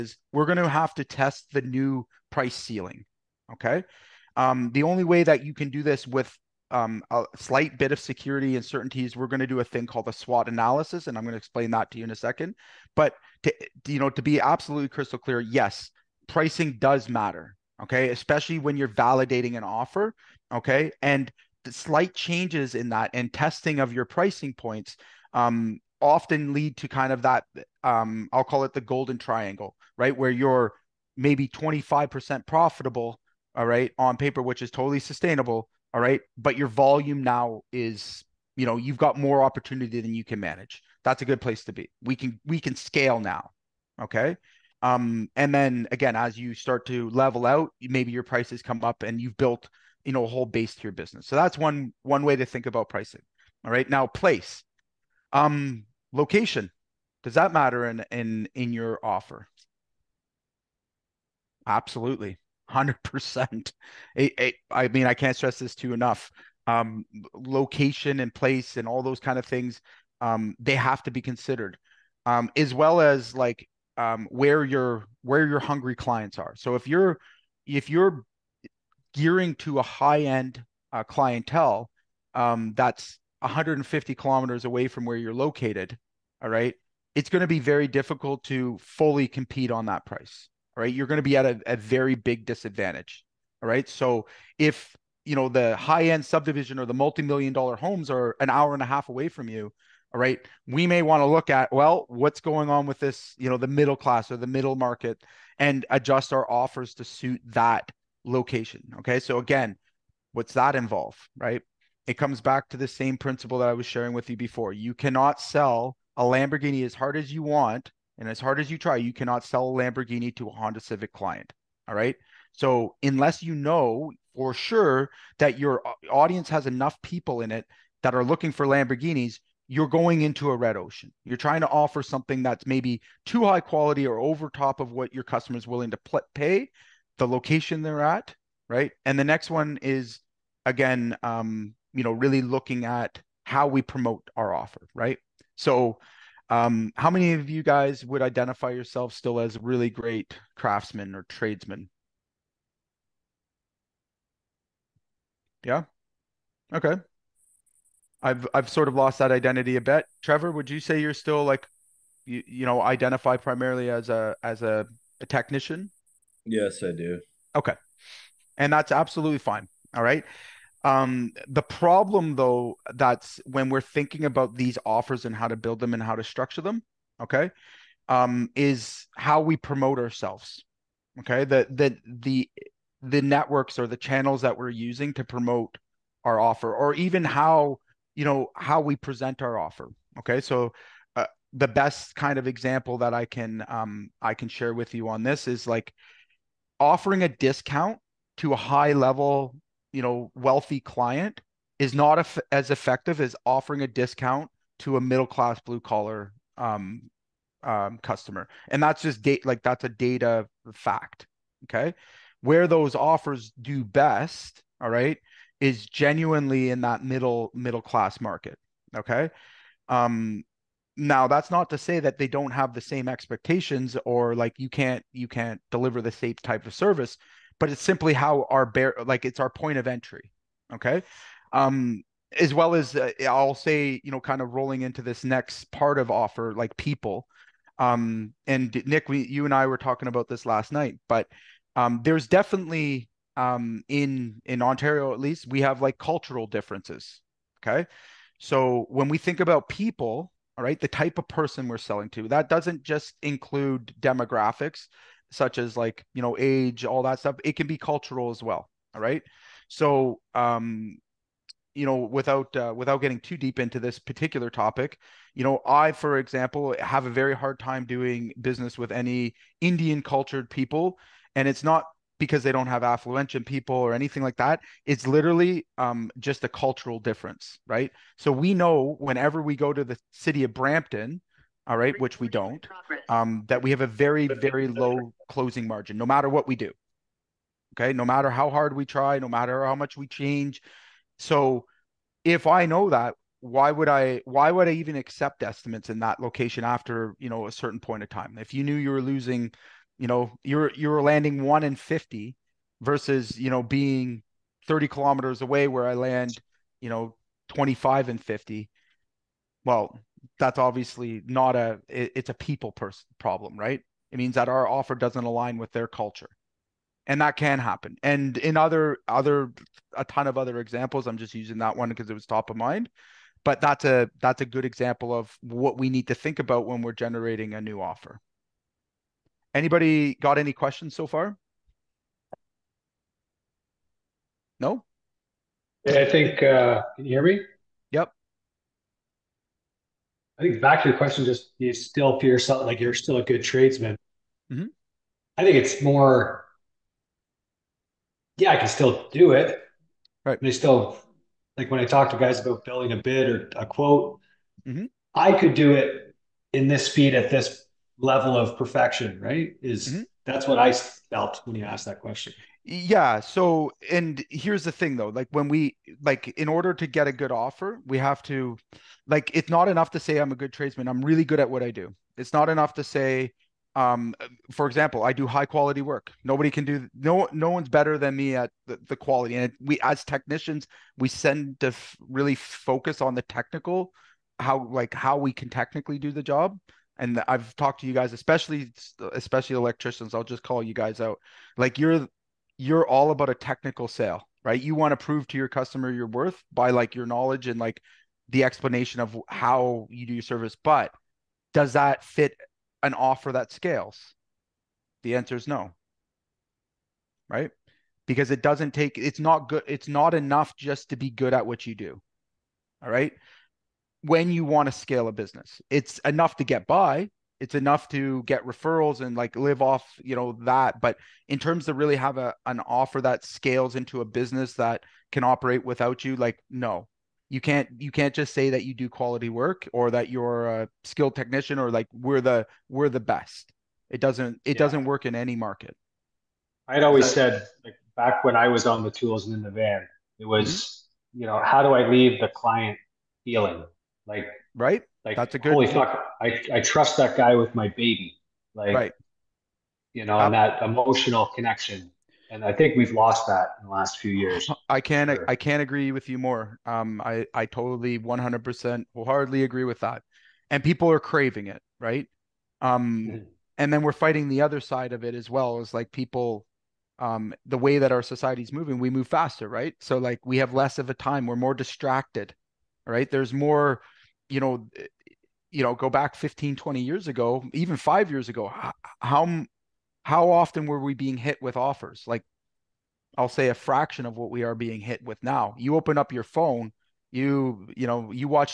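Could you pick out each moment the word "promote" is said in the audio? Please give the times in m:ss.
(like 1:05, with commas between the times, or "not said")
2:23, 2:59, 3:05.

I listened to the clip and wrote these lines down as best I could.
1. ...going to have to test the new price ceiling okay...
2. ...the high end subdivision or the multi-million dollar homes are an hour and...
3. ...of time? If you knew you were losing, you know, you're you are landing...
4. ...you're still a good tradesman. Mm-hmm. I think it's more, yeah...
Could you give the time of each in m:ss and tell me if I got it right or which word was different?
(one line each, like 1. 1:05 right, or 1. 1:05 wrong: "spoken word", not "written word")
1. 0:00 right
2. 1:35 right
3. 4:58 right
4. 5:42 right.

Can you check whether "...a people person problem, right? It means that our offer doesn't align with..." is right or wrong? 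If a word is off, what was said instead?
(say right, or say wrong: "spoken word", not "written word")
right.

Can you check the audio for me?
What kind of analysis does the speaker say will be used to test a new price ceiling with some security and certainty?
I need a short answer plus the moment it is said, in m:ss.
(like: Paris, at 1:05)
SWOT analysis, at 0:10.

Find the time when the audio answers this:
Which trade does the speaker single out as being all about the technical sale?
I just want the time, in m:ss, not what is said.
6:29.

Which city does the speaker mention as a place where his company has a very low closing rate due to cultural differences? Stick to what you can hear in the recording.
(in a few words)
Brampton.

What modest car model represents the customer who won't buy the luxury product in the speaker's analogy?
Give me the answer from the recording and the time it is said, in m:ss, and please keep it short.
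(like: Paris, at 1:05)
Honda Civic, at 2:00.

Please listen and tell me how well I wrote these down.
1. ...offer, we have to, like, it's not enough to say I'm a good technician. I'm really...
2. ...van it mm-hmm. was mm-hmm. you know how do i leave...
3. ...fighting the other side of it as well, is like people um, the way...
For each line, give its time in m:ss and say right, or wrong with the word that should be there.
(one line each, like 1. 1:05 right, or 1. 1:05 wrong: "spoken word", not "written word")
1. 6:07 wrong: "tradesman", not "technician"
2. 7:19 right
3. 7:43 right.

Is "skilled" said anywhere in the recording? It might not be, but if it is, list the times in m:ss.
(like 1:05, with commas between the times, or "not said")
7:10.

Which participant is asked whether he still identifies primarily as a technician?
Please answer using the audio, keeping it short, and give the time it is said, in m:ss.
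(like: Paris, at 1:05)
Trevor, at 2:40.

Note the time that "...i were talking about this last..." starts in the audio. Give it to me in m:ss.
3:59.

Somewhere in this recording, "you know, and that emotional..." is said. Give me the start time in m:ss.
7:29.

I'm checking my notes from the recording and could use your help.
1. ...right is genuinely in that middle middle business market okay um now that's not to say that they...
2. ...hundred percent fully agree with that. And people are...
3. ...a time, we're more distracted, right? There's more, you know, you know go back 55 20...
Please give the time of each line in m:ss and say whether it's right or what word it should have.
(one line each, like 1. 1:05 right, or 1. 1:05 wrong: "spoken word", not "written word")
1. 3:34 wrong: "class", not "business"
2. 7:38 wrong: "wholeheartedly", not "fully"
3. 7:50 wrong: "15", not "55".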